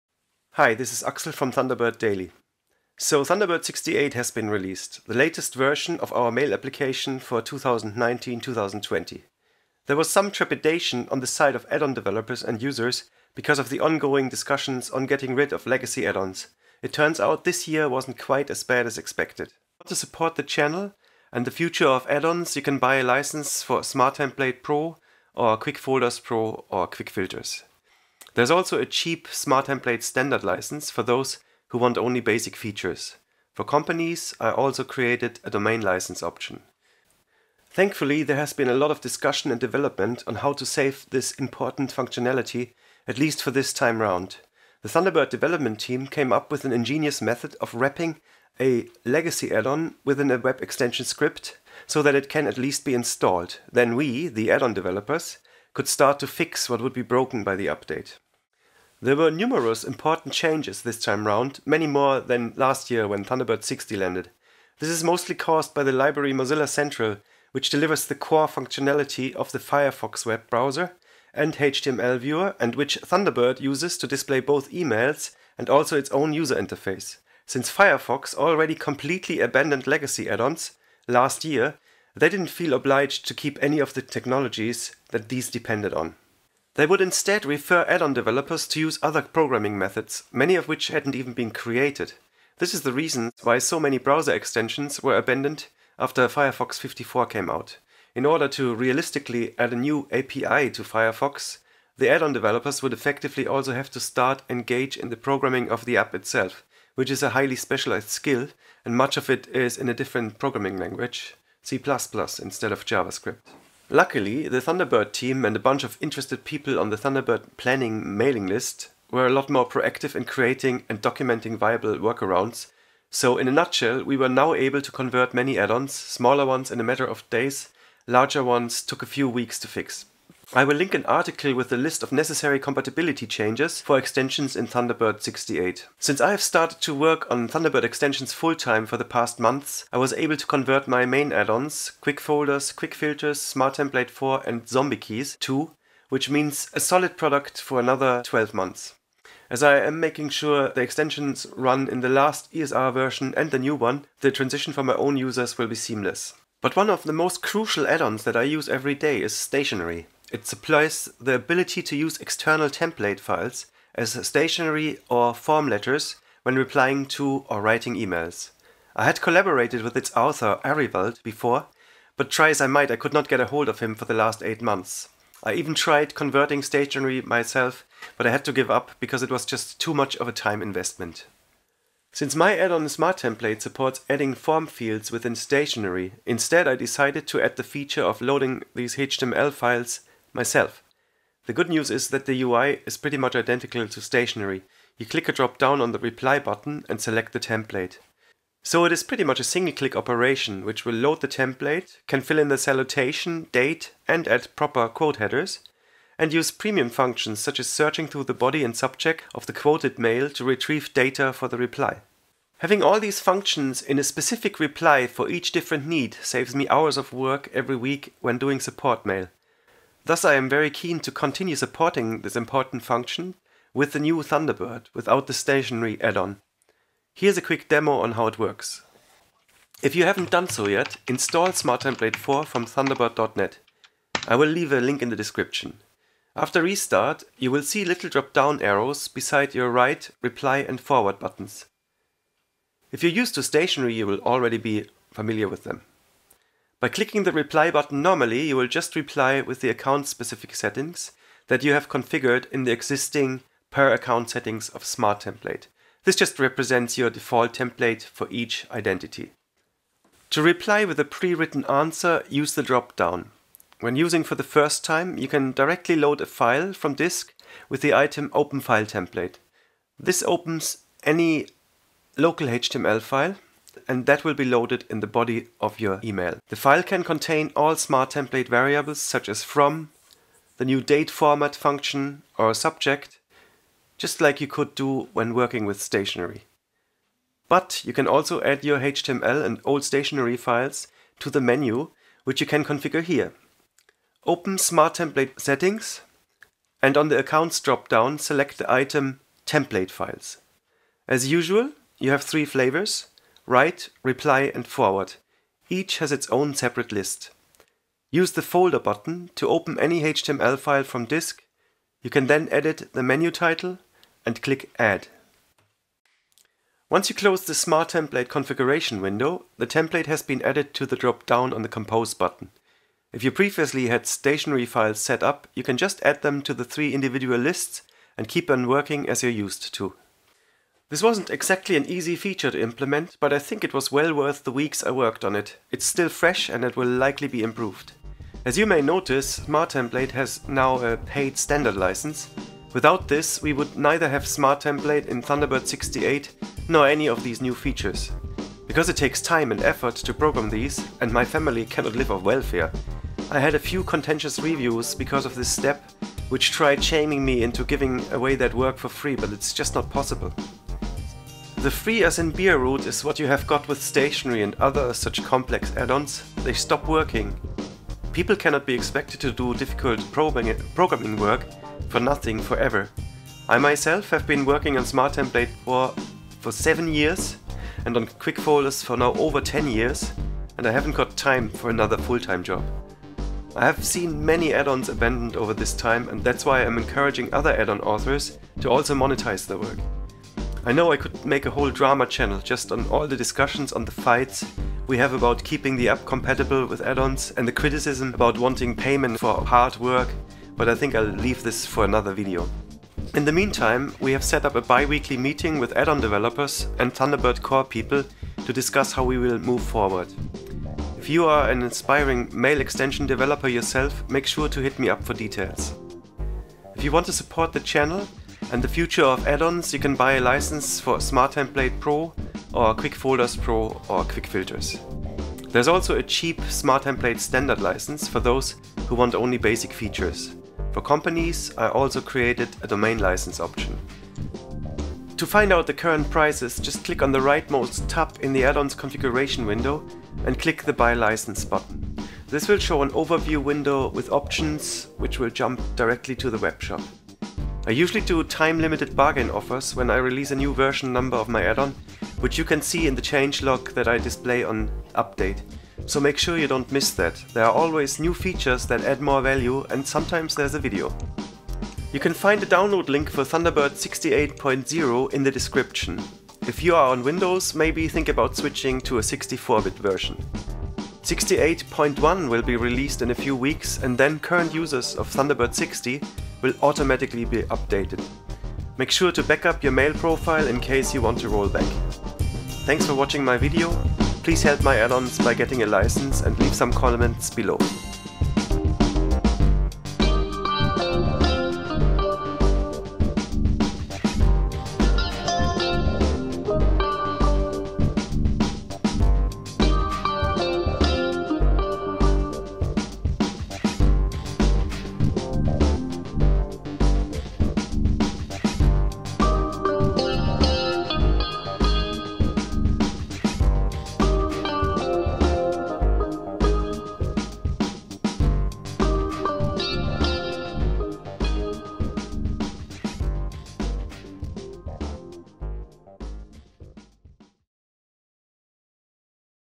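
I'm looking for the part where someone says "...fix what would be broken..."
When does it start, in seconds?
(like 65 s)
56 s.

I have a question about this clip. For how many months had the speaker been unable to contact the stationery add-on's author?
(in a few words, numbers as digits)
8.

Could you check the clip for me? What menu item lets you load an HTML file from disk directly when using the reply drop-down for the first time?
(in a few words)
Open File Template.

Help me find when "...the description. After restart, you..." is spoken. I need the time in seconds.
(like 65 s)
235 s.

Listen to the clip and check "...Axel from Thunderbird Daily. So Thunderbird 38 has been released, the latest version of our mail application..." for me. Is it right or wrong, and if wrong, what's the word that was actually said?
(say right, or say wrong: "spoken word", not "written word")
wrong: "68", not "38".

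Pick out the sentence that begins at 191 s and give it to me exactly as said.
The good news is that the UI is pretty much identical to stationery.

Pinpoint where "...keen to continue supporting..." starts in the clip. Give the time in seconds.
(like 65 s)
220 s.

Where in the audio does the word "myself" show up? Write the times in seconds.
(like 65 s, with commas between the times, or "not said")
177 s, 190 s, 373 s.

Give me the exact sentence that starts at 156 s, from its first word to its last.
But one of the most crucial add-ons that I use every day is stationery.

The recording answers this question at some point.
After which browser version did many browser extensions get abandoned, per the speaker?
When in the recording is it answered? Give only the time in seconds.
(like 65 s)
96 s.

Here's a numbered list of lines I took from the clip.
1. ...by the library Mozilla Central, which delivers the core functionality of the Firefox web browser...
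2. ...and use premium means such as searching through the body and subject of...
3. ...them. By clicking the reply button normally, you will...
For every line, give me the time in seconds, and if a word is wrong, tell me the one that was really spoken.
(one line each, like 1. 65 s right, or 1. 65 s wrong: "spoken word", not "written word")
1. 65 s right
2. 206 s wrong: "functions", not "means"
3. 245 s right.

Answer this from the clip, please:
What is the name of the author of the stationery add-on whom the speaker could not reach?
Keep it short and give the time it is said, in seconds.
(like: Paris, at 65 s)
Arivald, at 170 s.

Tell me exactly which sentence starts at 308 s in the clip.
Use the folder button to open any HTML file from disk.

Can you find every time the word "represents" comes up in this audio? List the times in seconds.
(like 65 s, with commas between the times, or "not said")
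256 s.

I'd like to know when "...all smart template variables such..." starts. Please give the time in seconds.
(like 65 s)
277 s.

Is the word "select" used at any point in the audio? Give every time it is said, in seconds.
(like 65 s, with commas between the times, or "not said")
197 s, 298 s.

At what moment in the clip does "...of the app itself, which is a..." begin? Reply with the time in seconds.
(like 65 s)
105 s.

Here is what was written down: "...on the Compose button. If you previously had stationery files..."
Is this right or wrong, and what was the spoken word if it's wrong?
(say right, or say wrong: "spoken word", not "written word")
right.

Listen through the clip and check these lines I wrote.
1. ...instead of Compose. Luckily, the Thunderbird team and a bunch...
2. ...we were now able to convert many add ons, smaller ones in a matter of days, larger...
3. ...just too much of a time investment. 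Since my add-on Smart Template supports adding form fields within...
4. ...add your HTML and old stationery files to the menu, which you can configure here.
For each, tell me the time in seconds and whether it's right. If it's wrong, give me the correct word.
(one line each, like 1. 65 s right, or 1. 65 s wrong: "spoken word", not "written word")
1. 112 s wrong: "JavaScript", not "Compose"
2. 124 s right
3. 179 s right
4. 288 s right.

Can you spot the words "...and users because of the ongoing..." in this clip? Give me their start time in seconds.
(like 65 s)
12 s.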